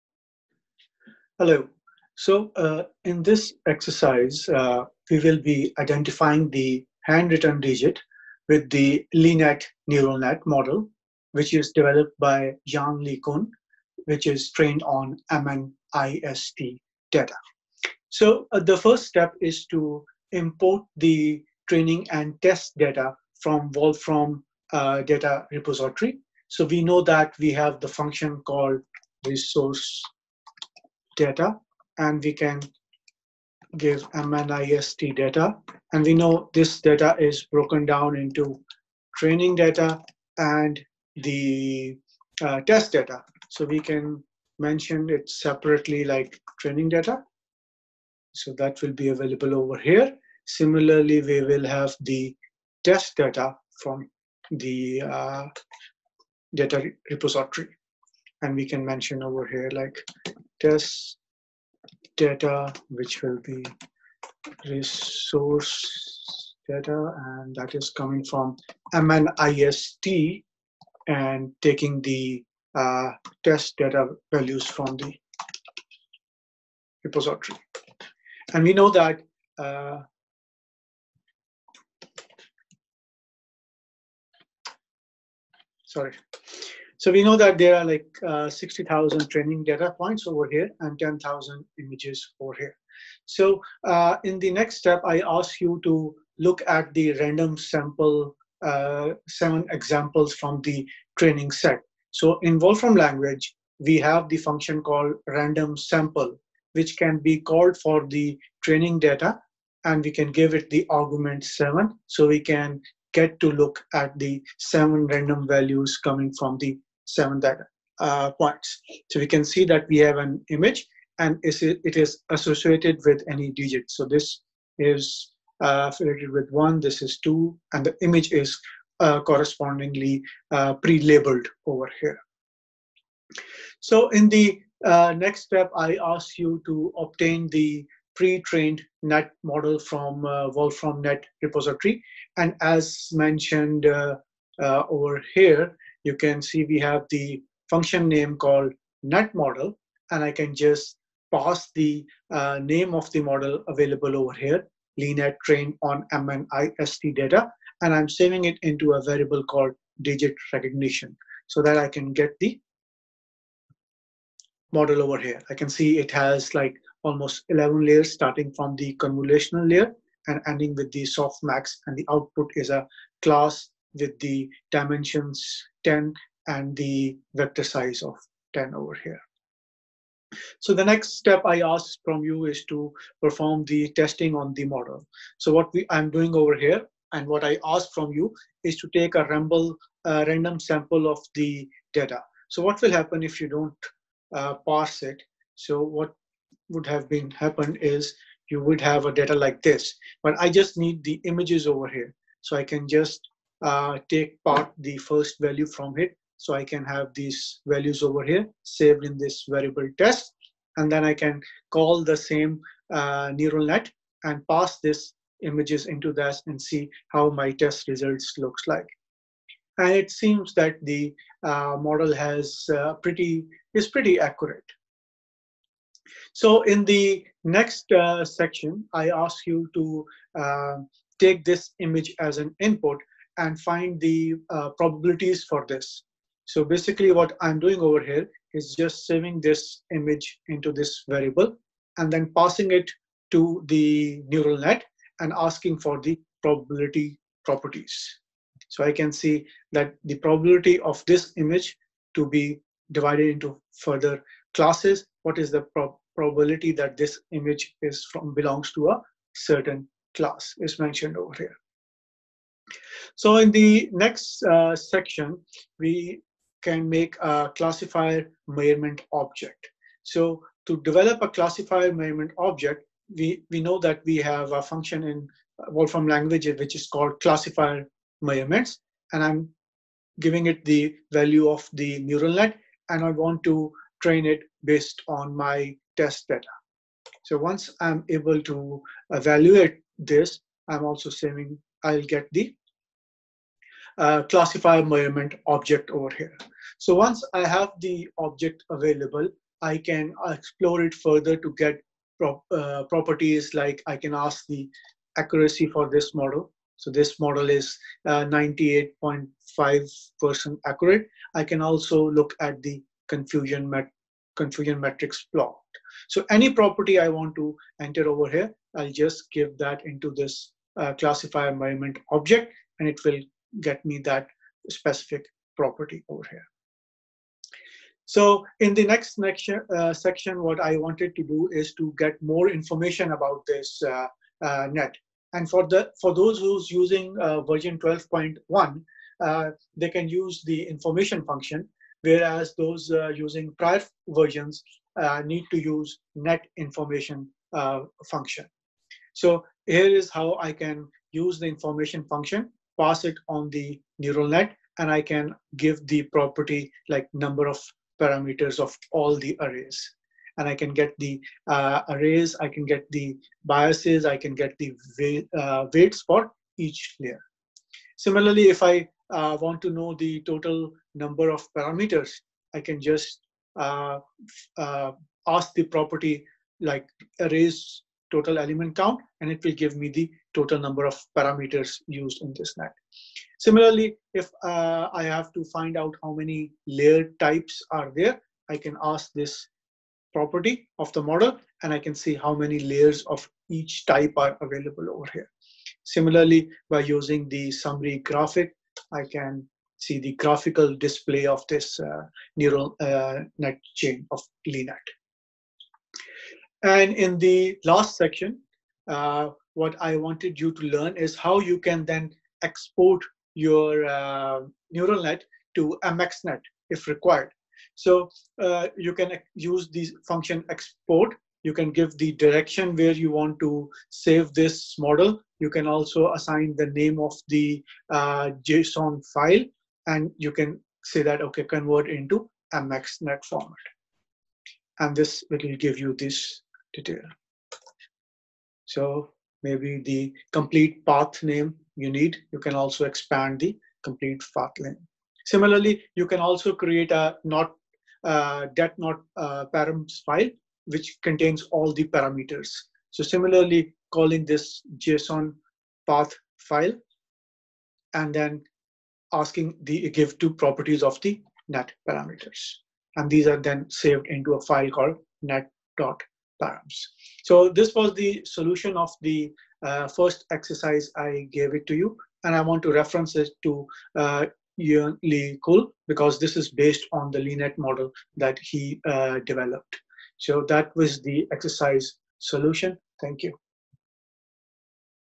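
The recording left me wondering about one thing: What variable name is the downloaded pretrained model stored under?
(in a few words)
digit recognition.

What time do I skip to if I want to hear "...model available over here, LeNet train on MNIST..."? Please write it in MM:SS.
02:33.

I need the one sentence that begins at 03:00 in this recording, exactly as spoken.
So the next step I ask from you is to perform the testing on the model.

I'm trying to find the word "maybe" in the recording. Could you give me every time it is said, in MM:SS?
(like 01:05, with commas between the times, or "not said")
07:19.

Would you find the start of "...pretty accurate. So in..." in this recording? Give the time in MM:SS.
03:43.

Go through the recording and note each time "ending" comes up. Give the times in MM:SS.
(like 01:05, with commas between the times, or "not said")
02:50.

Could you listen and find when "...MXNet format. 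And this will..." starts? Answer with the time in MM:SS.
07:12.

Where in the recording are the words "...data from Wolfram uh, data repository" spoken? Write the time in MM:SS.
00:22.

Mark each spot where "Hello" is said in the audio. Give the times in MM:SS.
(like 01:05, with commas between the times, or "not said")
00:01.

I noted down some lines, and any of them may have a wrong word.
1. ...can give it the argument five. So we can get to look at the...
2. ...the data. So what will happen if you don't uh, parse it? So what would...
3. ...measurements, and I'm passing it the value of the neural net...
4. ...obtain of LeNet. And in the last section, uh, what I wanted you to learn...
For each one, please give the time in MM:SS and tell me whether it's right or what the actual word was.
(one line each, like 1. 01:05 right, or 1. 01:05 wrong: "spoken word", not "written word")
1. 01:50 wrong: "seven", not "five"
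2. 03:11 right
3. 04:38 wrong: "giving", not "passing"
4. 06:43 wrong: "chain", not "obtain".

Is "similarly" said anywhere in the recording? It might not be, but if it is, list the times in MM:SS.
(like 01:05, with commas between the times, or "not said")
00:50, 06:07, 06:23, 06:35, 07:25, 07:33.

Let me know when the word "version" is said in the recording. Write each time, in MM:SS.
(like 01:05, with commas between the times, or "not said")
05:37, 05:44.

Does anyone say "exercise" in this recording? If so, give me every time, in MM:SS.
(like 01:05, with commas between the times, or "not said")
00:03, 07:50, 08:01.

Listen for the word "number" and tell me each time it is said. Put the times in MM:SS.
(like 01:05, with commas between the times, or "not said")
05:57, 06:10, 06:20.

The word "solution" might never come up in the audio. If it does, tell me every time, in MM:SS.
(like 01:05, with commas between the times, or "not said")
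07:48, 08:02.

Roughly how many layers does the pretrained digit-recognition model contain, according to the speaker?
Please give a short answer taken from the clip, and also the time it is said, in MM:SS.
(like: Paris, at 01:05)
11, at 02:47.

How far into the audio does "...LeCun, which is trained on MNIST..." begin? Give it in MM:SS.
00:13.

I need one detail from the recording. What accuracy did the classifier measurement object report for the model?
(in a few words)
98.5%.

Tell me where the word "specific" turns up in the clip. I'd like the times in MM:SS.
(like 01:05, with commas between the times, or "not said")
05:24.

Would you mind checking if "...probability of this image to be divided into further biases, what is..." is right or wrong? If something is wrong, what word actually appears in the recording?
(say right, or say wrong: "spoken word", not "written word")
wrong: "classes", not "biases".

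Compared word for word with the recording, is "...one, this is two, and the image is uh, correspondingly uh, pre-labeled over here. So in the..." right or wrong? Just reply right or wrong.
right.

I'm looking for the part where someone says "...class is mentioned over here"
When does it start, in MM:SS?
04:20.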